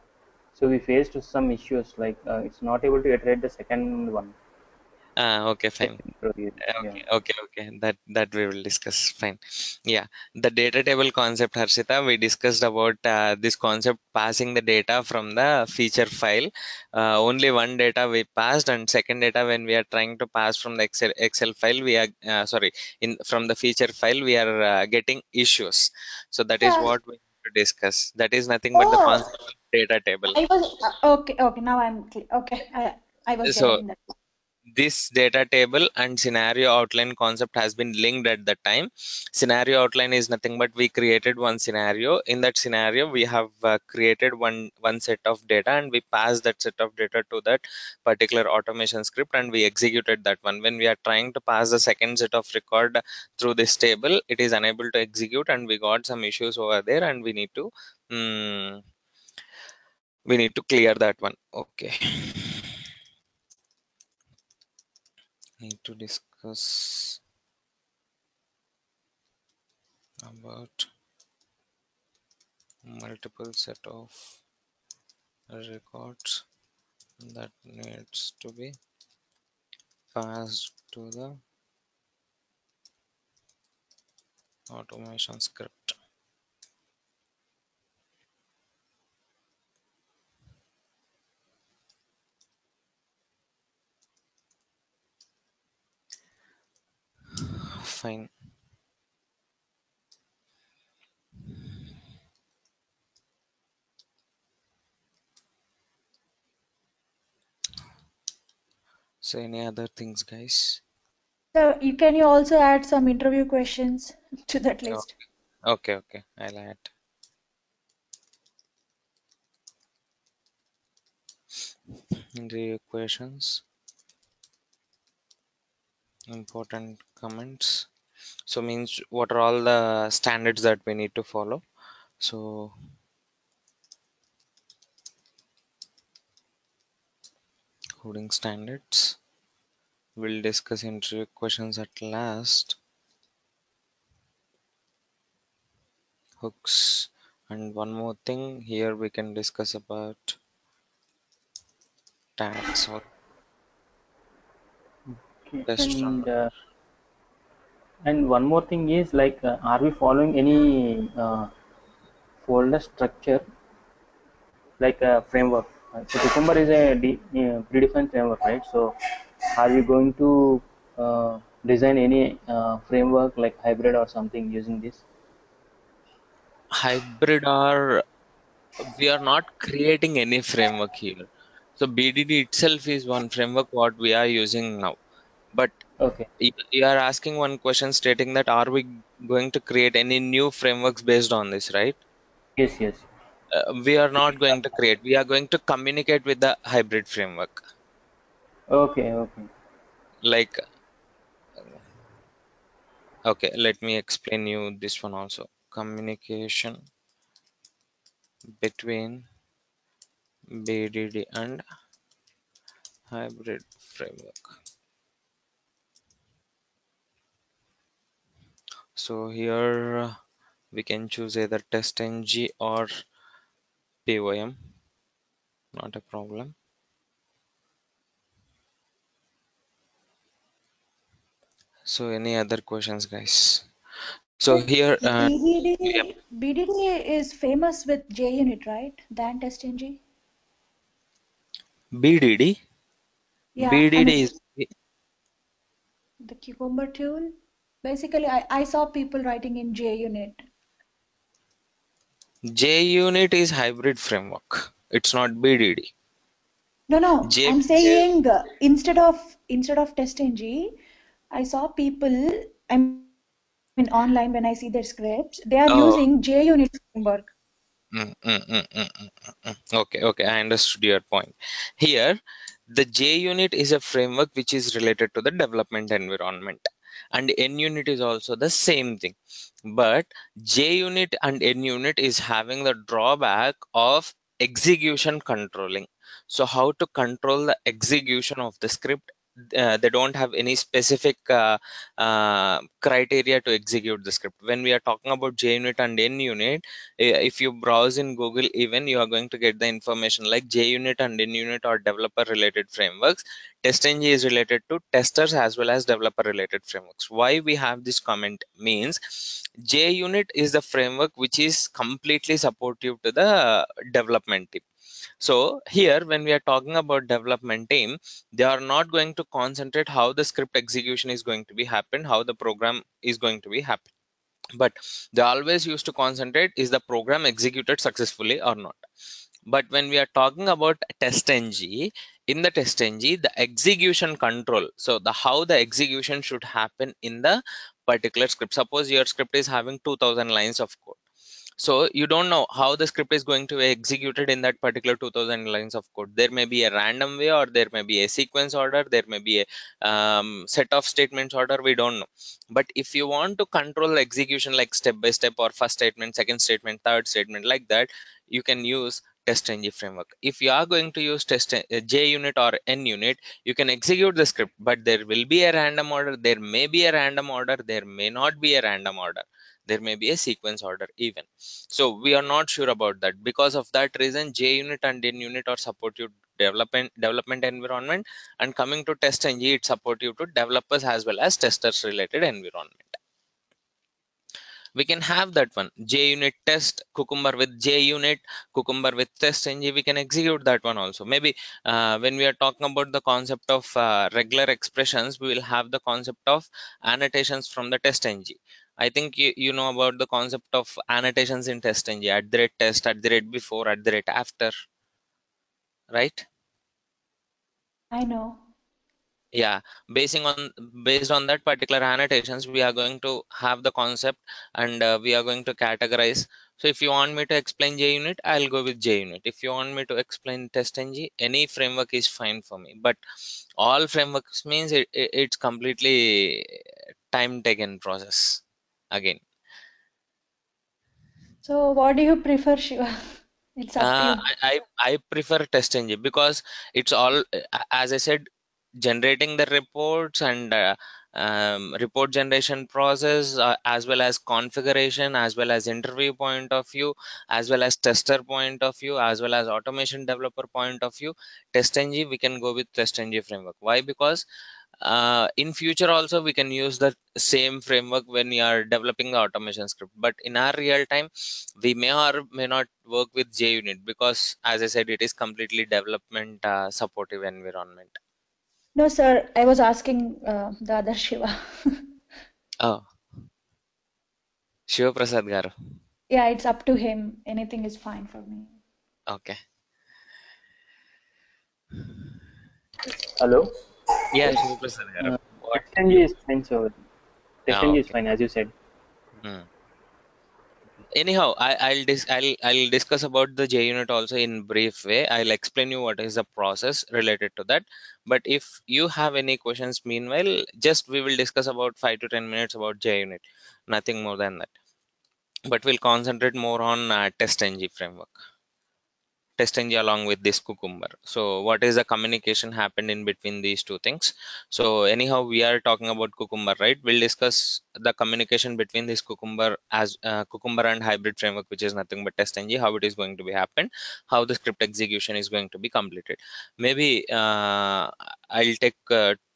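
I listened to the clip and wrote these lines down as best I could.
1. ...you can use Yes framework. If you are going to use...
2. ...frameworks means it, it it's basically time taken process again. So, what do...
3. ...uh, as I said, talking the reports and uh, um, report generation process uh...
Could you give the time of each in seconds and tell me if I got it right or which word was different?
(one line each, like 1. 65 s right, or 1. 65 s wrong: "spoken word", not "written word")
1. 358 s wrong: "TestNG", not "Yes"
2. 423 s wrong: "completely", not "basically"
3. 437 s wrong: "generating", not "talking".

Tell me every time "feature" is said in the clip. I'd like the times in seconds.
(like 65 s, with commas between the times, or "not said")
15 s, 23 s.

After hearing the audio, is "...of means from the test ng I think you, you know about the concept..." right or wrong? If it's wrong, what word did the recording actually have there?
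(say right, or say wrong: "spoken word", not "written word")
wrong: "annotations", not "means".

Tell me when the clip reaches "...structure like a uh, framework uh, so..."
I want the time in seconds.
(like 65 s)
162 s.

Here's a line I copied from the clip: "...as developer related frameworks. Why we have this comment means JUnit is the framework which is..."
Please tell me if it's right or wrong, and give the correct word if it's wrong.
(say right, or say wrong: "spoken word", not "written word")
right.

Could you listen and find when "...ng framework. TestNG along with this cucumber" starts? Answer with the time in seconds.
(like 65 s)
507 s.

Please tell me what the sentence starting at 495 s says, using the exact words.
I'll explain you what is the process related to that.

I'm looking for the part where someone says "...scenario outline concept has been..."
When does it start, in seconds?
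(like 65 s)
36 s.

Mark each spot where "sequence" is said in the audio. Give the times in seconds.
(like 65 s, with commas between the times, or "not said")
348 s, 370 s.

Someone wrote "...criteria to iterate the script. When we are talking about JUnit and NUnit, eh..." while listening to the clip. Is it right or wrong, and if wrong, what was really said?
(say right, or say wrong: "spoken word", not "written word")
wrong: "execute", not "iterate".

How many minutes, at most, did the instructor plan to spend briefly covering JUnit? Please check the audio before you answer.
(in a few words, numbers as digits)
ten minutes.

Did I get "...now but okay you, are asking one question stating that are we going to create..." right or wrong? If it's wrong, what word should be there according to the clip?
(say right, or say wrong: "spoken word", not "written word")
right.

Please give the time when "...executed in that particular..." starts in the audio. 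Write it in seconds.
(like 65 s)
343 s.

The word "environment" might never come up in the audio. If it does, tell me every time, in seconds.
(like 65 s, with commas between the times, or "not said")
275 s, 377 s, 382 s, 467 s.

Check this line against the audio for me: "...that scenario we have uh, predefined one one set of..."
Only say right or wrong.
wrong.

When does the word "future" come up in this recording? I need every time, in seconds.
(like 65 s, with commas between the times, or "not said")
455 s.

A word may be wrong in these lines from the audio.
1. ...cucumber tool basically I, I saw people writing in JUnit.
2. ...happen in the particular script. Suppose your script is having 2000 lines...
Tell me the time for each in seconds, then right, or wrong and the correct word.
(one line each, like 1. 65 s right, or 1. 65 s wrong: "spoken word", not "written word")
1. 246 s right
2. 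336 s right.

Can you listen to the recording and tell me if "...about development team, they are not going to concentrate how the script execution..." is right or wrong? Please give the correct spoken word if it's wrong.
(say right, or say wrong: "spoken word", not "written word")
right.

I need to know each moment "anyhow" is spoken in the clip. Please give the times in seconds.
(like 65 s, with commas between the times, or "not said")
490 s, 514 s.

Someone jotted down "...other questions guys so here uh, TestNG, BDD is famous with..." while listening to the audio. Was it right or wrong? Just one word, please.
wrong.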